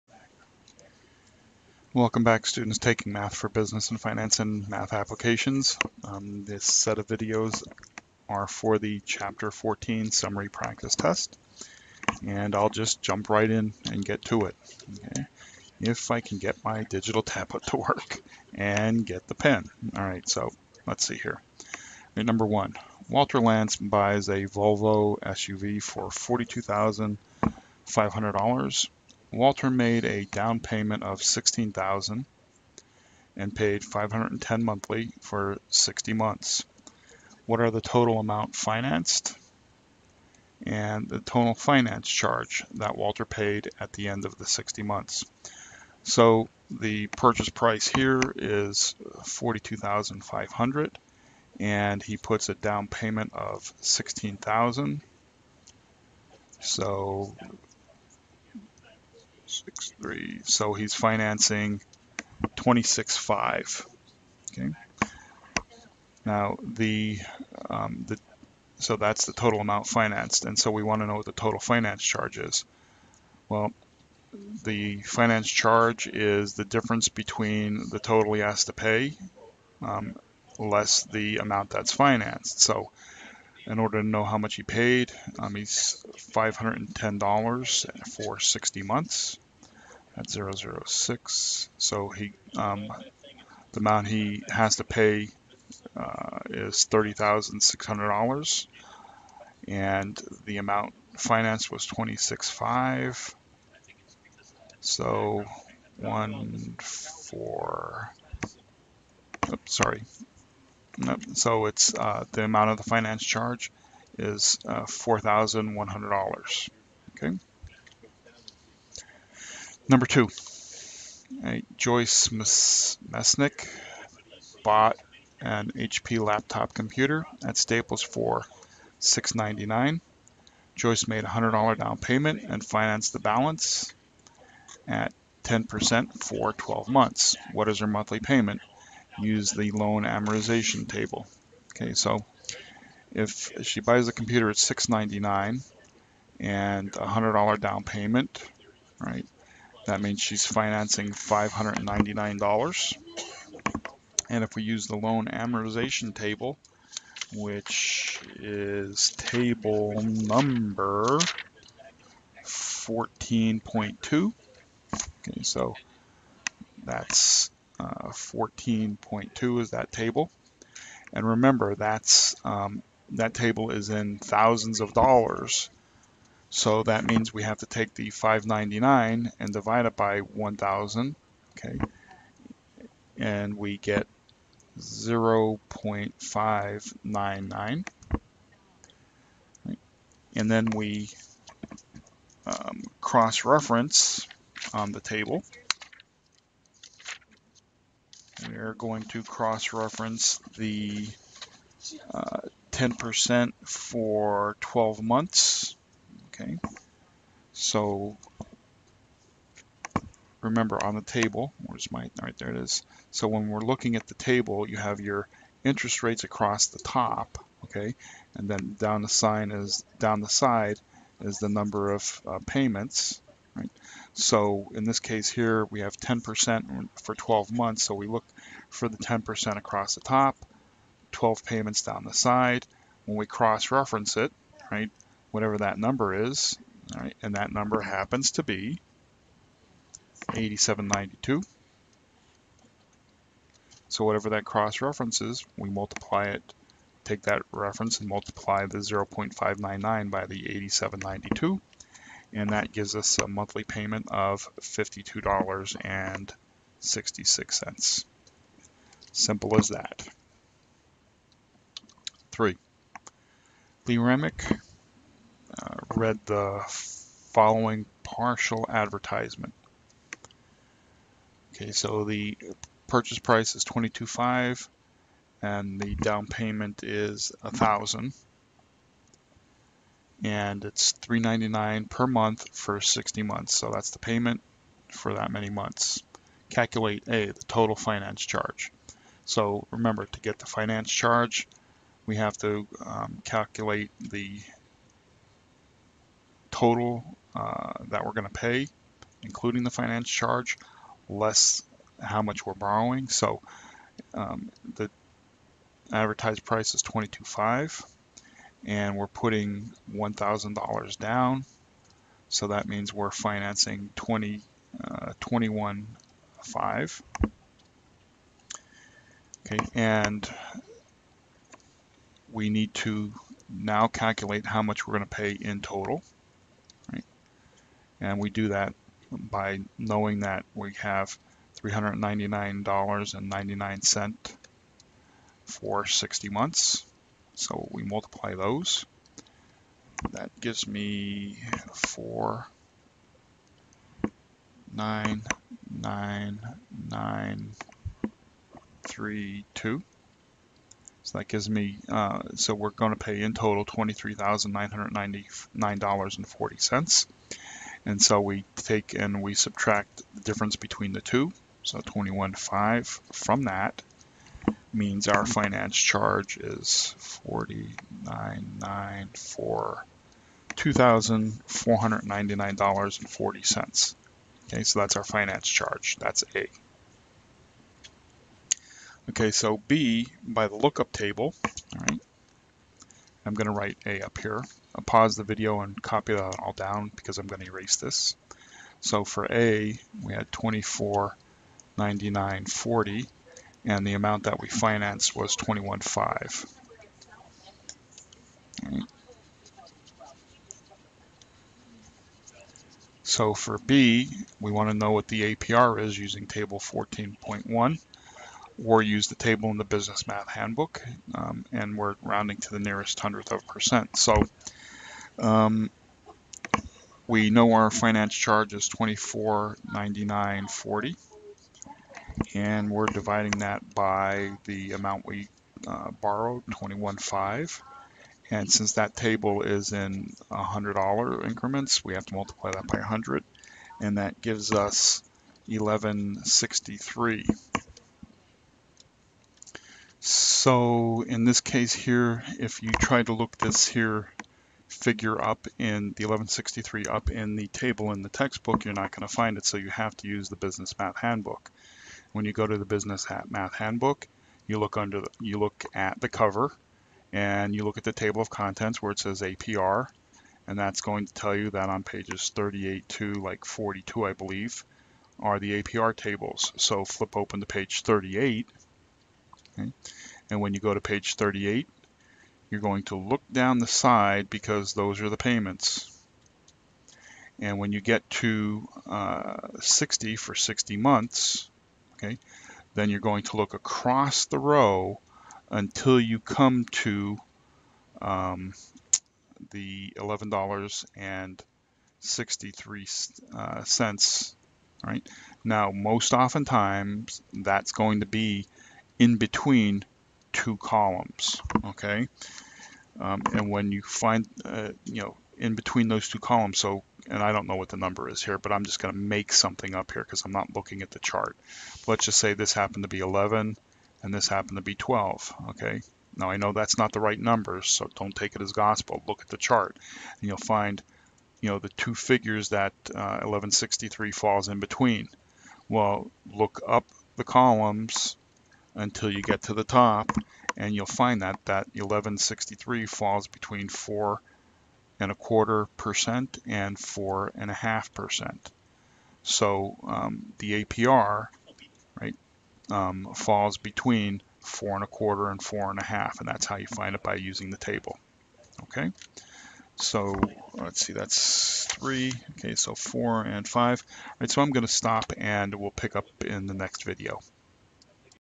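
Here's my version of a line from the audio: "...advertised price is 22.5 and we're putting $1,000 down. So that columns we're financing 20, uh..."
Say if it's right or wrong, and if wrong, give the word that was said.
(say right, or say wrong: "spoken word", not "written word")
wrong: "means", not "columns".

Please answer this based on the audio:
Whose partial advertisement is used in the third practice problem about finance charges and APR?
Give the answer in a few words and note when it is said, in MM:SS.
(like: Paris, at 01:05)
Lee Remick, at 04:23.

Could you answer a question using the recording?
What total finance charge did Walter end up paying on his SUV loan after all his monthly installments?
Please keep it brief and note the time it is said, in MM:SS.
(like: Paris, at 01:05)
$4,100, at 01:54.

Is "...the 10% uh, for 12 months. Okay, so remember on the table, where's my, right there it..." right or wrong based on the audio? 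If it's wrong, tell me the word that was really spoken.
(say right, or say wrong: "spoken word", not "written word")
right.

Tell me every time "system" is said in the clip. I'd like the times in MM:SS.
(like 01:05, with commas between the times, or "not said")
not said.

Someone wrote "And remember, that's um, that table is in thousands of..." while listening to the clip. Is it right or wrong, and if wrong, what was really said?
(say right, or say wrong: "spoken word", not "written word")
right.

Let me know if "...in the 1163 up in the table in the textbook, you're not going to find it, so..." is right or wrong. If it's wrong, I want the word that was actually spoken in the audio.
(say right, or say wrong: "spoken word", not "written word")
right.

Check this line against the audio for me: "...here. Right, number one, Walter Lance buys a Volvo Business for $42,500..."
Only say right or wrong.
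wrong.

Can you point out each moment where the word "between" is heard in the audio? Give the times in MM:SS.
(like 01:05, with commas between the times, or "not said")
01:17, 06:00, 08:19, 08:25, 08:44, 08:53, 09:03.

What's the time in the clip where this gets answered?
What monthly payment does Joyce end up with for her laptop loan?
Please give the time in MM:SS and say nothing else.
04:14.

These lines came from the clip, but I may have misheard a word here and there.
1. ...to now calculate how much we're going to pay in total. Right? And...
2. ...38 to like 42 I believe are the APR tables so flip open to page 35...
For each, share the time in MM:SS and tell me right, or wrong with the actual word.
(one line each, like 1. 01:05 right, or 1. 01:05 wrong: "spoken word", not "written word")
1. 05:22 right
2. 07:42 wrong: "38", not "35".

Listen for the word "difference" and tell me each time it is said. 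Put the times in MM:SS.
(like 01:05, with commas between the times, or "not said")
01:16, 06:00.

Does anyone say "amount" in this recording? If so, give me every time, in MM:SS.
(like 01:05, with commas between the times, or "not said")
00:38, 01:09, 01:21, 01:33, 01:40, 01:52, 06:33, 07:04.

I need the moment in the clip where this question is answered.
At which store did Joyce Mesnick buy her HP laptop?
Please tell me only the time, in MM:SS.
02:07.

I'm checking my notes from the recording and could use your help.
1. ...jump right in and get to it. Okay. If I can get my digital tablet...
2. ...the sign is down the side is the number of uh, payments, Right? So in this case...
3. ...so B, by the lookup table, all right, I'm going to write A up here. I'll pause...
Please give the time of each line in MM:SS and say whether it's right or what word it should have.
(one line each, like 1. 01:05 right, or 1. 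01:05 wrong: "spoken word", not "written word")
1. 00:13 right
2. 03:39 right
3. 06:19 right.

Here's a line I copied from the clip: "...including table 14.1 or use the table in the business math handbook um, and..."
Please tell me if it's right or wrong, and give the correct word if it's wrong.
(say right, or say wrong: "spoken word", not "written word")
wrong: "using", not "including".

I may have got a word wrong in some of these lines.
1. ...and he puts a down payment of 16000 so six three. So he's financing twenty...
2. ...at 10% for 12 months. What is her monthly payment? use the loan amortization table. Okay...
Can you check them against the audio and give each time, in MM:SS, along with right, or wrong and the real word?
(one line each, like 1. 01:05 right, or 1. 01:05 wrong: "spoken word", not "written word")
1. 00:51 right
2. 02:14 right.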